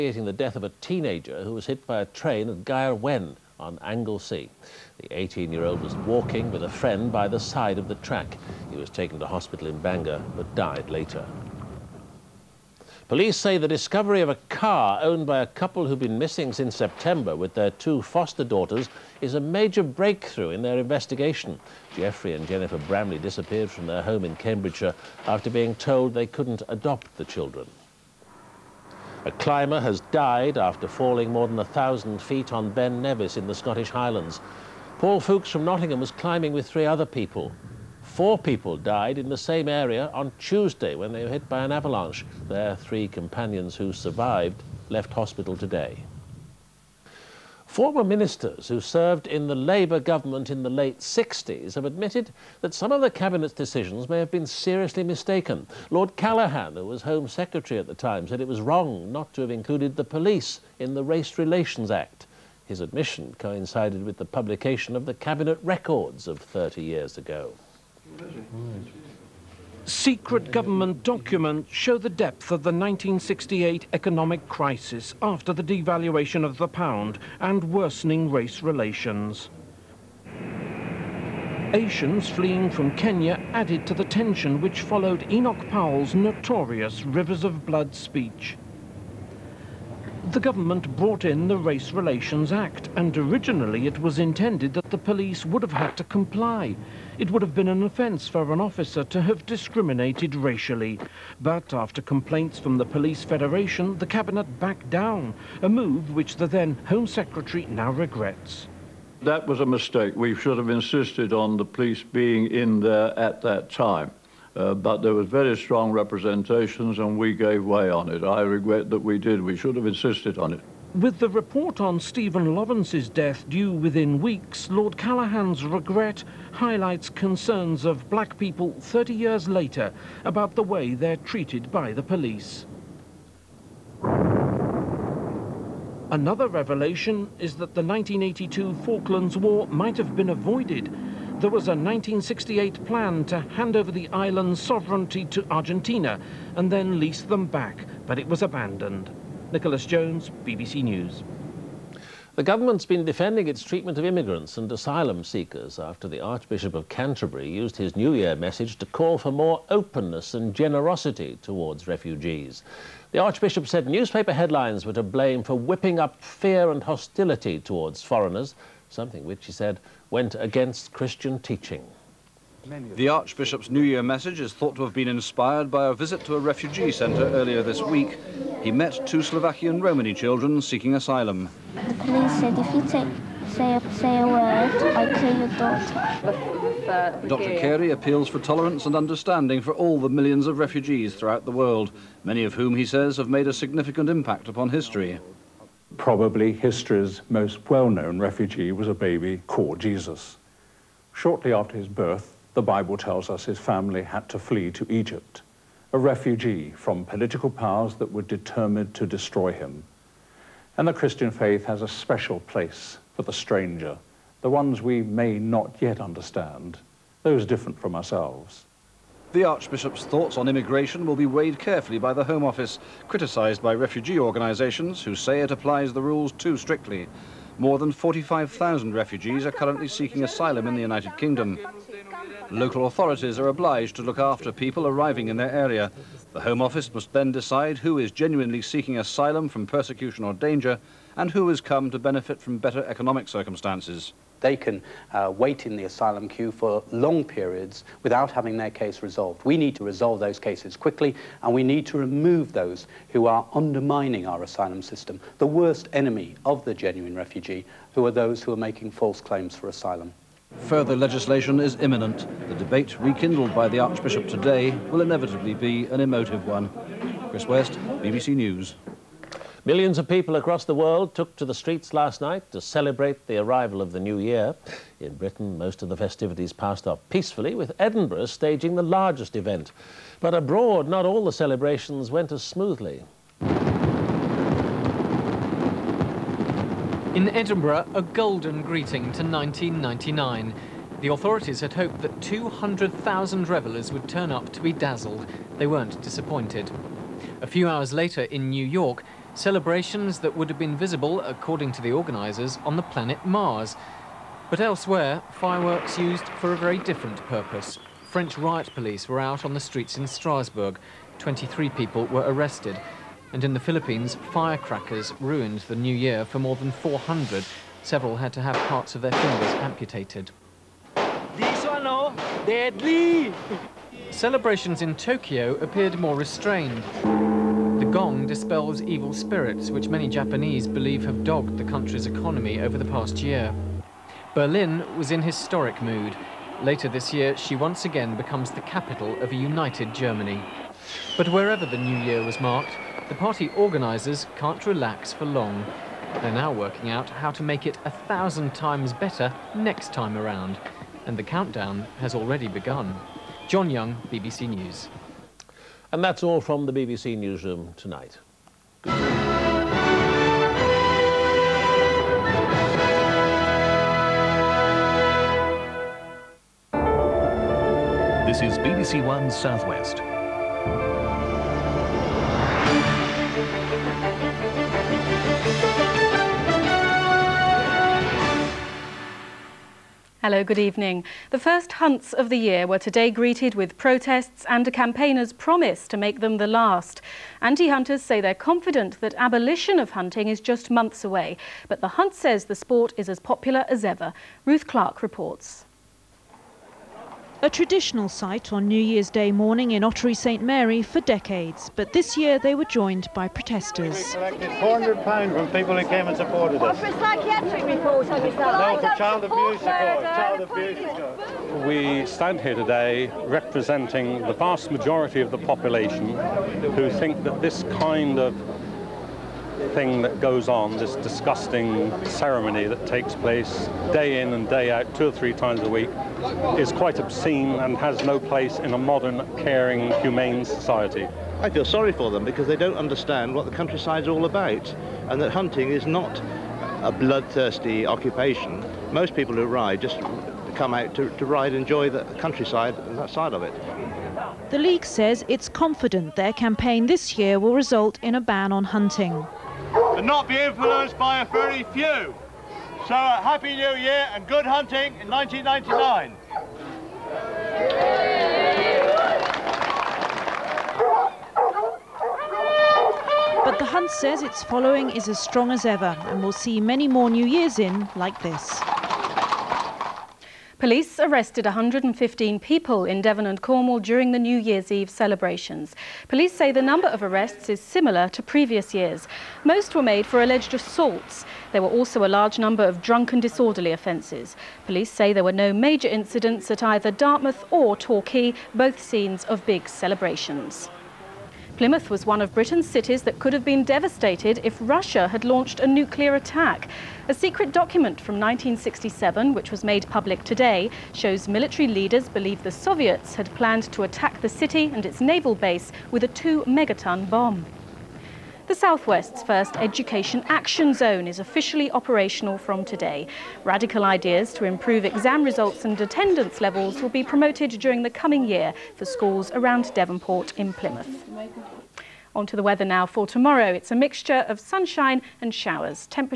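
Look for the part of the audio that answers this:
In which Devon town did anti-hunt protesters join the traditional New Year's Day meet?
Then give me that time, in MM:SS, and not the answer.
06:39.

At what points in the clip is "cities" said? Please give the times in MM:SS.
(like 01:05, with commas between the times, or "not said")
08:12.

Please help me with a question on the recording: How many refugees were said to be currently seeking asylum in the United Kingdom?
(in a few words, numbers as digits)
45,000.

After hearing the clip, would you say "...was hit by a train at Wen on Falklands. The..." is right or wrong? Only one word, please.
wrong.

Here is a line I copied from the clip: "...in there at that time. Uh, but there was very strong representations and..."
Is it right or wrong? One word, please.
right.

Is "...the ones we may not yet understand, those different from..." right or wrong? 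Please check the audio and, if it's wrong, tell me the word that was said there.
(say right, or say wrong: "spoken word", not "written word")
right.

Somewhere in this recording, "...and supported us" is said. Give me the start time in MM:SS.
06:46.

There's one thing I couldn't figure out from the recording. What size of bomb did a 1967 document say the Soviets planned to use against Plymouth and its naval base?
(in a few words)
2 megaton.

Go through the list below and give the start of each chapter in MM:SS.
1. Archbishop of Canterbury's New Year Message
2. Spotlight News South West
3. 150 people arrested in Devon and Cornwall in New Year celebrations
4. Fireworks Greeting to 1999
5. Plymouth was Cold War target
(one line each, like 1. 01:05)
1. 02:32
2. 06:11
3. 07:50
4. 04:29
5. 08:11.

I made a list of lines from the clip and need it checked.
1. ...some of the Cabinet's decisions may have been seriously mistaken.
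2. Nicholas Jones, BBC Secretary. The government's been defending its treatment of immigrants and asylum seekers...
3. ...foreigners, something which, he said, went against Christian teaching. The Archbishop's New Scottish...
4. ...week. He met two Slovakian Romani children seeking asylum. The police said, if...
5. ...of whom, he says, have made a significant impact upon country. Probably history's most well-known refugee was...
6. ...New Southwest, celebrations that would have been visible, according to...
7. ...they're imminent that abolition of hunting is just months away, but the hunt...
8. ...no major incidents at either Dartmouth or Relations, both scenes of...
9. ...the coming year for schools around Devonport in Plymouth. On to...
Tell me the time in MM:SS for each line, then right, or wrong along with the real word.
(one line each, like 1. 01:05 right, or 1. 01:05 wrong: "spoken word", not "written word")
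1. 00:52 right
2. 02:29 wrong: "News", not "Secretary"
3. 02:48 wrong: "Year", not "Scottish"
4. 02:57 right
5. 03:12 wrong: "history", not "country"
6. 04:58 wrong: "York", not "Southwest"
7. 06:28 wrong: "confident", not "imminent"
8. 08:05 wrong: "Torquay", not "Relations"
9. 08:37 right.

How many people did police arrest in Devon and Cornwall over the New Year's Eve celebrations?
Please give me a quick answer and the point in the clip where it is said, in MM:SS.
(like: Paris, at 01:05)
115, at 07:51.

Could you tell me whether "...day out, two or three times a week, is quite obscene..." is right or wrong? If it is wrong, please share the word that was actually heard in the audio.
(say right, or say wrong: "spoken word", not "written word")
right.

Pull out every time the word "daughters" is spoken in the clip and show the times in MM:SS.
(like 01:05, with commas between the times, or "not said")
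00:18, 03:06.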